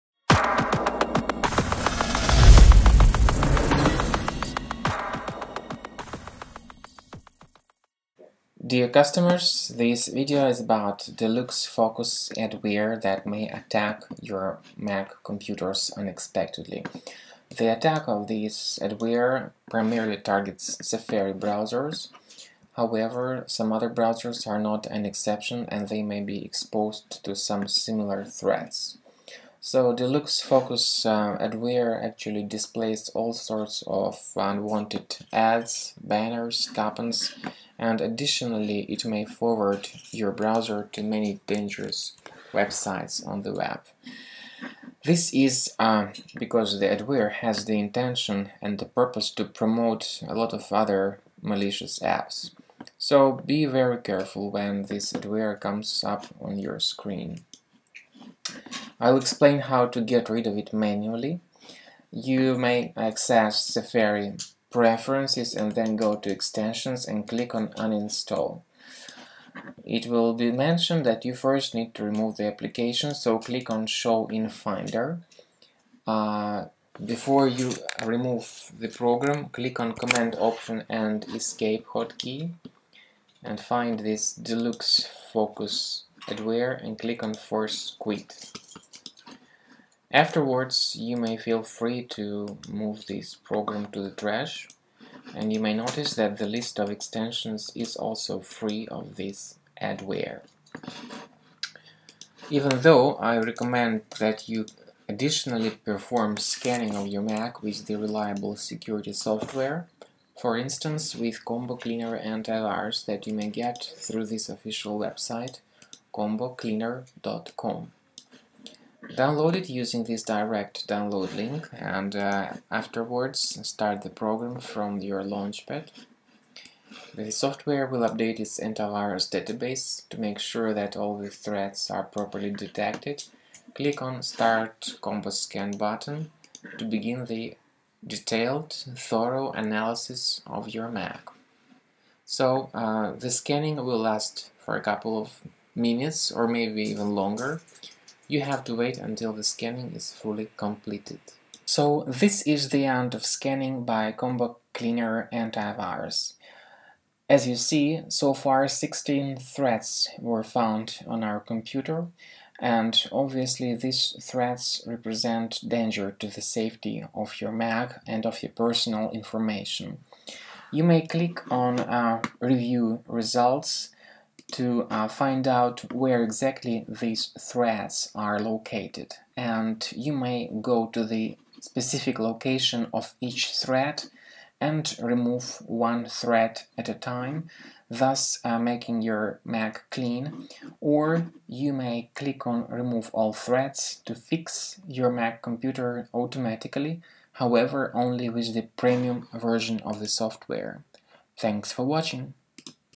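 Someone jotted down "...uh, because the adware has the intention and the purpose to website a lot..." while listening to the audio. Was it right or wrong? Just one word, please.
wrong.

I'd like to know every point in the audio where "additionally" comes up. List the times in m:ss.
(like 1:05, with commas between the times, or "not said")
0:38, 1:45.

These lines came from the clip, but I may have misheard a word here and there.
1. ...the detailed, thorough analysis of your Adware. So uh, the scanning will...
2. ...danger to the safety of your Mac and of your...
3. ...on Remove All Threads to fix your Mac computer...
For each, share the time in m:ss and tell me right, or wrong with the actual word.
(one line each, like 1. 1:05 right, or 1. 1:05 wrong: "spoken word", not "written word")
1. 2:17 wrong: "Mac", not "Adware"
2. 2:45 right
3. 3:12 right.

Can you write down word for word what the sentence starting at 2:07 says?
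The software will update its antivirus database to make sure that all the threats are properly detected.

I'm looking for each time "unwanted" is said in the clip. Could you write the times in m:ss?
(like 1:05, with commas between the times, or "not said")
0:34.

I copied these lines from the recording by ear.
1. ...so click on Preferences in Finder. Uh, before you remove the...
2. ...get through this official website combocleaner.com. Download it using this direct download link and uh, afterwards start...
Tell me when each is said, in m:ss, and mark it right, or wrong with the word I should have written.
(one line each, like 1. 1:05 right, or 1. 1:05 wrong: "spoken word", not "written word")
1. 1:13 wrong: "Show", not "Preferences"
2. 1:53 right.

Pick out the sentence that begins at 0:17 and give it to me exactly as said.
The attack of this adware primarily targets Safari browsers.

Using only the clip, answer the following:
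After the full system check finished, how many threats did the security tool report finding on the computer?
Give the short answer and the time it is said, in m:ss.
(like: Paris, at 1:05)
16, at 2:38.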